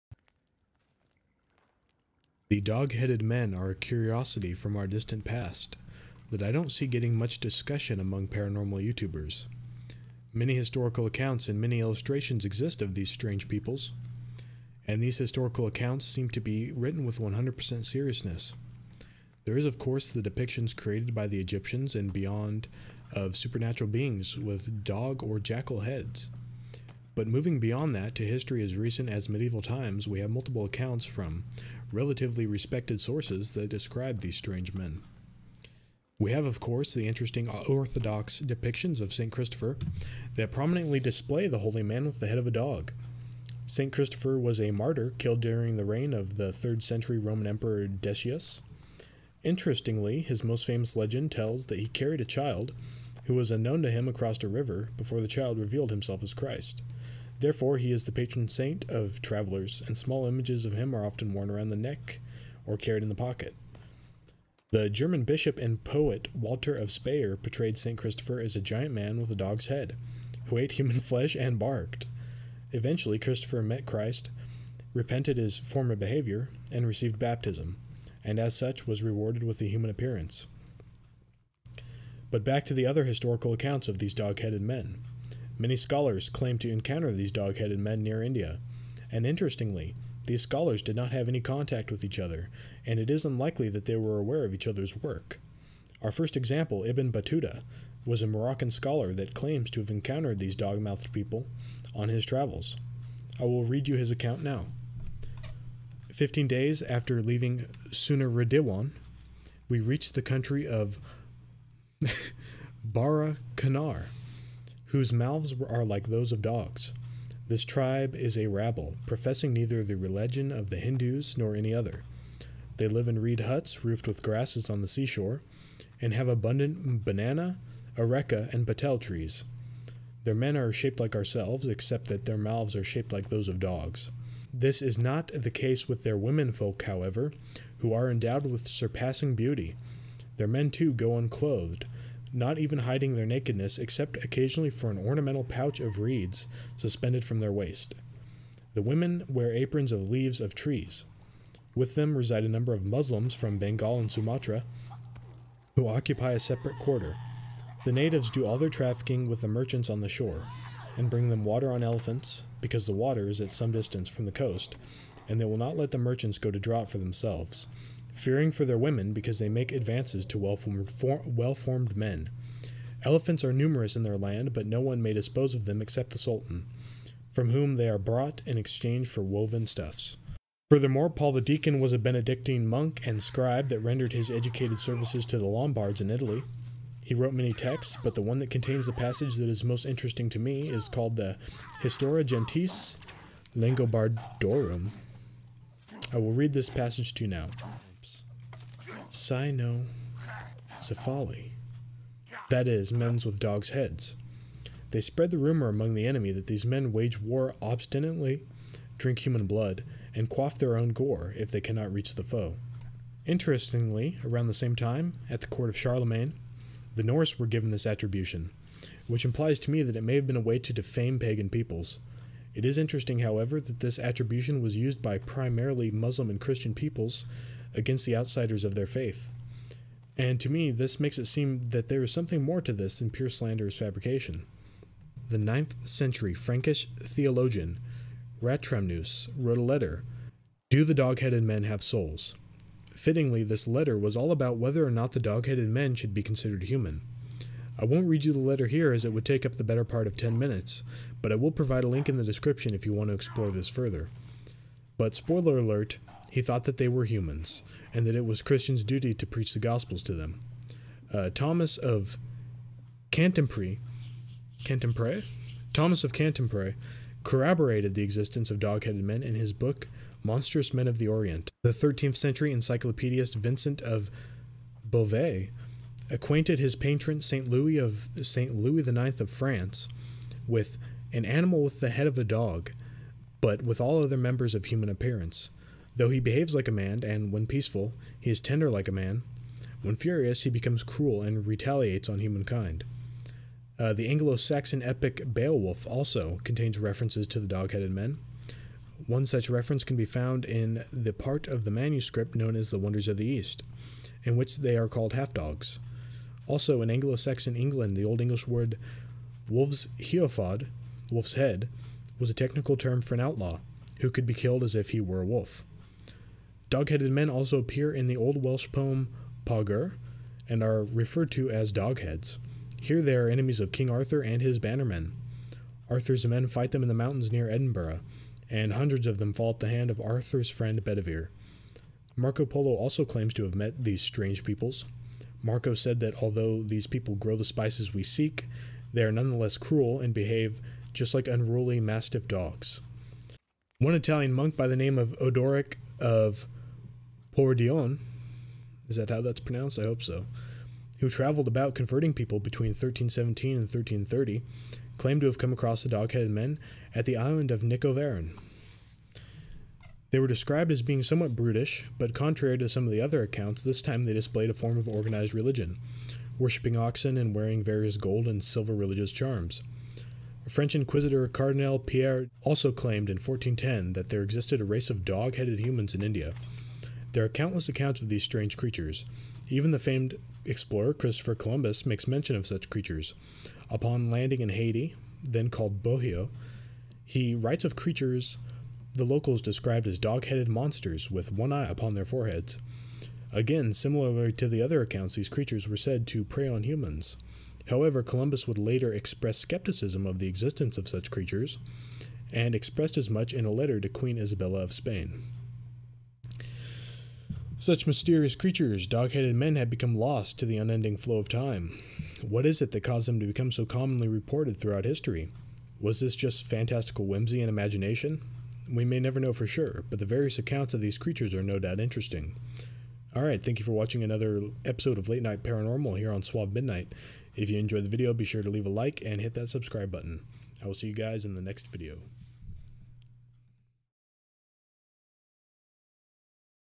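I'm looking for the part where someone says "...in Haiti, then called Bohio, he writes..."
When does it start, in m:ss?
6:24.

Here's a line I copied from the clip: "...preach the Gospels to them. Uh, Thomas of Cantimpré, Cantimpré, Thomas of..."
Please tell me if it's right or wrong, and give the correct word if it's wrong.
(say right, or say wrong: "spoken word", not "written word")
right.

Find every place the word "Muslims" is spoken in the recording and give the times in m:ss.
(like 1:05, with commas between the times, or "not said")
2:32, 3:45.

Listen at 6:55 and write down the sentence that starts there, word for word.
Was this just fantastical whimsy and imagination?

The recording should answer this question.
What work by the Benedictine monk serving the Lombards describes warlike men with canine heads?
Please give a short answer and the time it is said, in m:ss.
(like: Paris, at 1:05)
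Historia Gentis Langobardorum, at 3:11.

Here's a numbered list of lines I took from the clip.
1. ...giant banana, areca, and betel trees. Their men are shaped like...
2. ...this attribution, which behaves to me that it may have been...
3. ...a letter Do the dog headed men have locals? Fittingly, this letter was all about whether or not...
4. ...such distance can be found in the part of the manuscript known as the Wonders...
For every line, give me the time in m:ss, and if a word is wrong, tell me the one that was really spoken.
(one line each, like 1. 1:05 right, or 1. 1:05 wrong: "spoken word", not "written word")
1. 2:06 wrong: "abundant", not "giant"
2. 3:37 wrong: "implies", not "behaves"
3. 3:59 wrong: "souls", not "locals"
4. 4:59 wrong: "reference", not "distance".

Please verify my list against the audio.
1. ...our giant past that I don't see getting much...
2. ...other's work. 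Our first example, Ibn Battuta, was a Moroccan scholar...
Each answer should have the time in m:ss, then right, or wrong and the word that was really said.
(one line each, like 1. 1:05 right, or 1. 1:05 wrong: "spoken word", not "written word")
1. 0:04 wrong: "distant", not "giant"
2. 1:34 right.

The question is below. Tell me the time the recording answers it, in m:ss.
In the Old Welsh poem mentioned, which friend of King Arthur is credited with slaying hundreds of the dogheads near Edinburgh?
5:30.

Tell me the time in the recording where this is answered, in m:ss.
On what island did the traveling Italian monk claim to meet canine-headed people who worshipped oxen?
5:57.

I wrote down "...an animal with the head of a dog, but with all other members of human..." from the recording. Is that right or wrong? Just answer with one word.
right.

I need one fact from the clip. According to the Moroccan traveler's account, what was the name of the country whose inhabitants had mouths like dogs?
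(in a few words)
Bara Kanar.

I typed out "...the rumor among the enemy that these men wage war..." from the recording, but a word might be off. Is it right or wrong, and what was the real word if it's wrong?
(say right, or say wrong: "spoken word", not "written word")
right.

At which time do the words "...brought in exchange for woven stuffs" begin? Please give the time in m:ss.
2:57.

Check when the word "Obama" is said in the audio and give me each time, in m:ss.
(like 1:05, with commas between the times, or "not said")
not said.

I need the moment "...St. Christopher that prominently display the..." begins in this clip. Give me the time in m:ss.
0:39.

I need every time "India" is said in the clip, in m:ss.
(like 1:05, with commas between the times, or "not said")
1:28, 6:16.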